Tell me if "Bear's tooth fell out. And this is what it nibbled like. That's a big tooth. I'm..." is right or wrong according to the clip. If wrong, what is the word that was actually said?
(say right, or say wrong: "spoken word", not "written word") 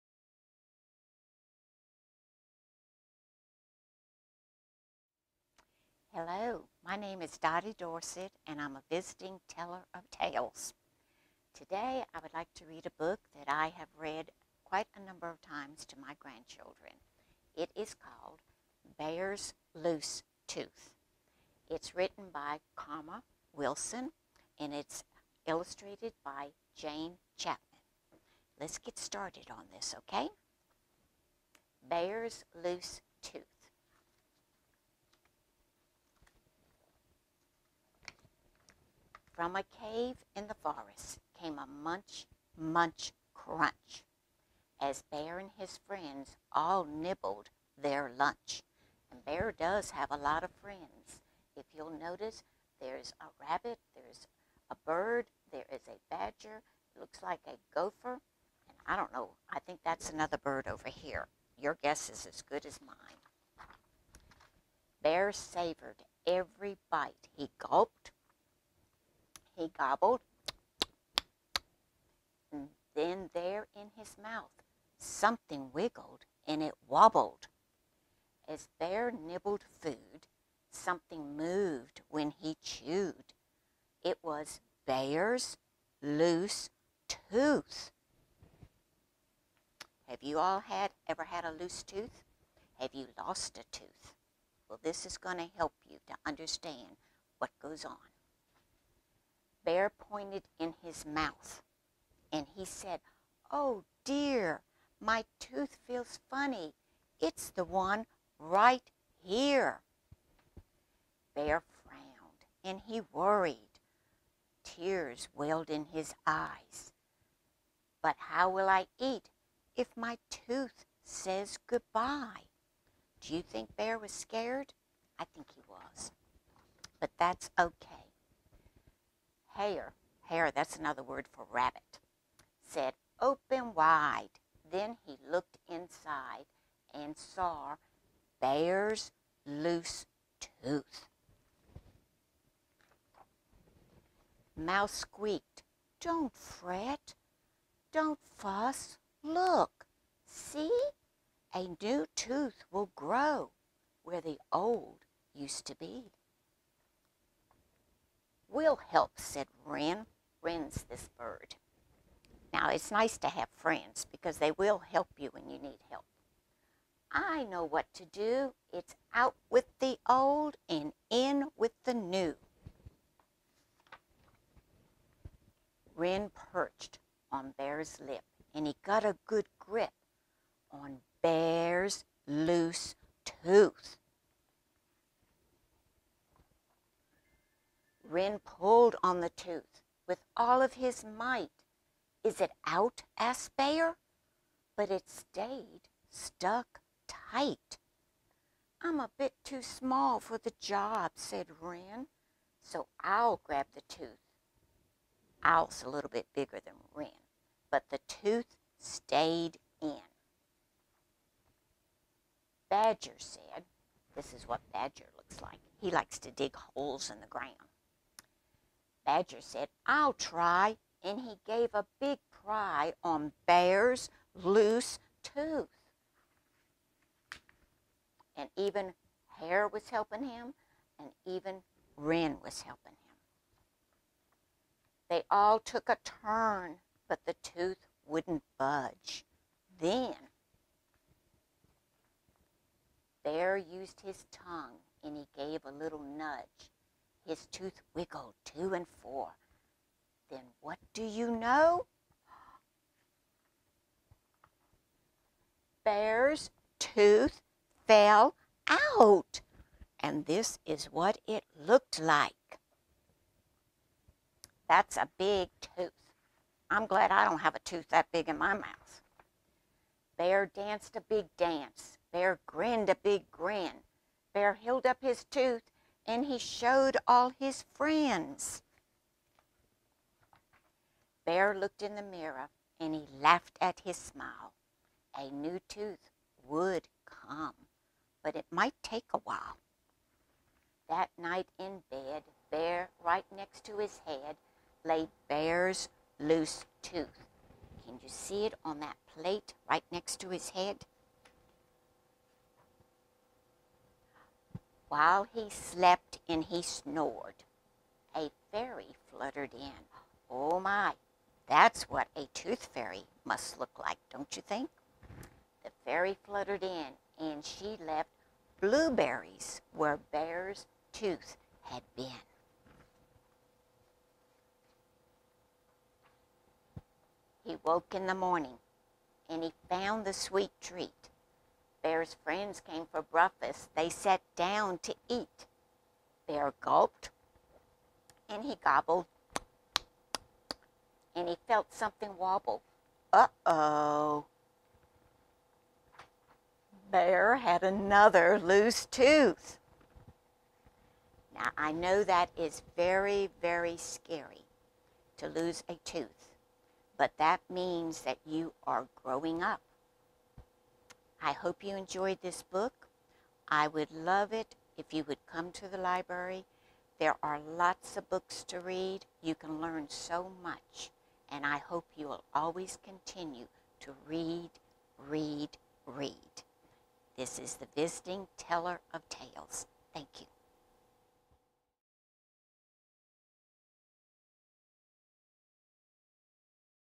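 wrong: "looked", not "nibbled".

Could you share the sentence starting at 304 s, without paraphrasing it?
while he slept and he snored, a fairy fluttered in.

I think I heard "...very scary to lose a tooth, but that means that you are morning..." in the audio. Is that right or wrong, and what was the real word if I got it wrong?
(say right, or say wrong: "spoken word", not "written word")
wrong: "growing", not "morning".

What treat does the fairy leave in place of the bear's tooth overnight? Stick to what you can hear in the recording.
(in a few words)
Blueberries.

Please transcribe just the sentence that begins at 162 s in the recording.
Now, it's nice to have friends because they will help you when you need help.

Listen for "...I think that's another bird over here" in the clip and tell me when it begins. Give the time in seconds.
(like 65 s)
59 s.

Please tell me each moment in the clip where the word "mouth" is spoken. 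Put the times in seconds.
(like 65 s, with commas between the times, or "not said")
74 s, 101 s, 268 s.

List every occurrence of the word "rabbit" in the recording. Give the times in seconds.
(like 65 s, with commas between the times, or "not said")
53 s, 131 s.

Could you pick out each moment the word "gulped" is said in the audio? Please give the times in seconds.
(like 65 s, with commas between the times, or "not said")
67 s, 336 s.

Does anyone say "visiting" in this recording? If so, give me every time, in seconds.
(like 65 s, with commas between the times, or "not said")
8 s, 377 s.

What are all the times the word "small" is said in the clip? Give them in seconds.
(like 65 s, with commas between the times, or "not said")
199 s.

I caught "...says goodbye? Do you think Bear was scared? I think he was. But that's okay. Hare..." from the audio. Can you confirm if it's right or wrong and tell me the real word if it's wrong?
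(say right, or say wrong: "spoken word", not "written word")
right.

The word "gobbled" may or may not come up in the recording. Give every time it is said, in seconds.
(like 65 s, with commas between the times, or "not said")
69 s, 338 s.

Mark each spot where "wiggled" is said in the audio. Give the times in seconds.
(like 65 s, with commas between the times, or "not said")
75 s, 247 s.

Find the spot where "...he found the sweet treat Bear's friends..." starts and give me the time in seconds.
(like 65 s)
329 s.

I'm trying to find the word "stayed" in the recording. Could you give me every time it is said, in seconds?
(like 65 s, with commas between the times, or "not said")
195 s, 208 s.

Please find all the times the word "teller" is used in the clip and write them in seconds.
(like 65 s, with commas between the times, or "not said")
9 s, 378 s.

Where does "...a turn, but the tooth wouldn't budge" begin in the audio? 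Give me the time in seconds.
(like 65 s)
235 s.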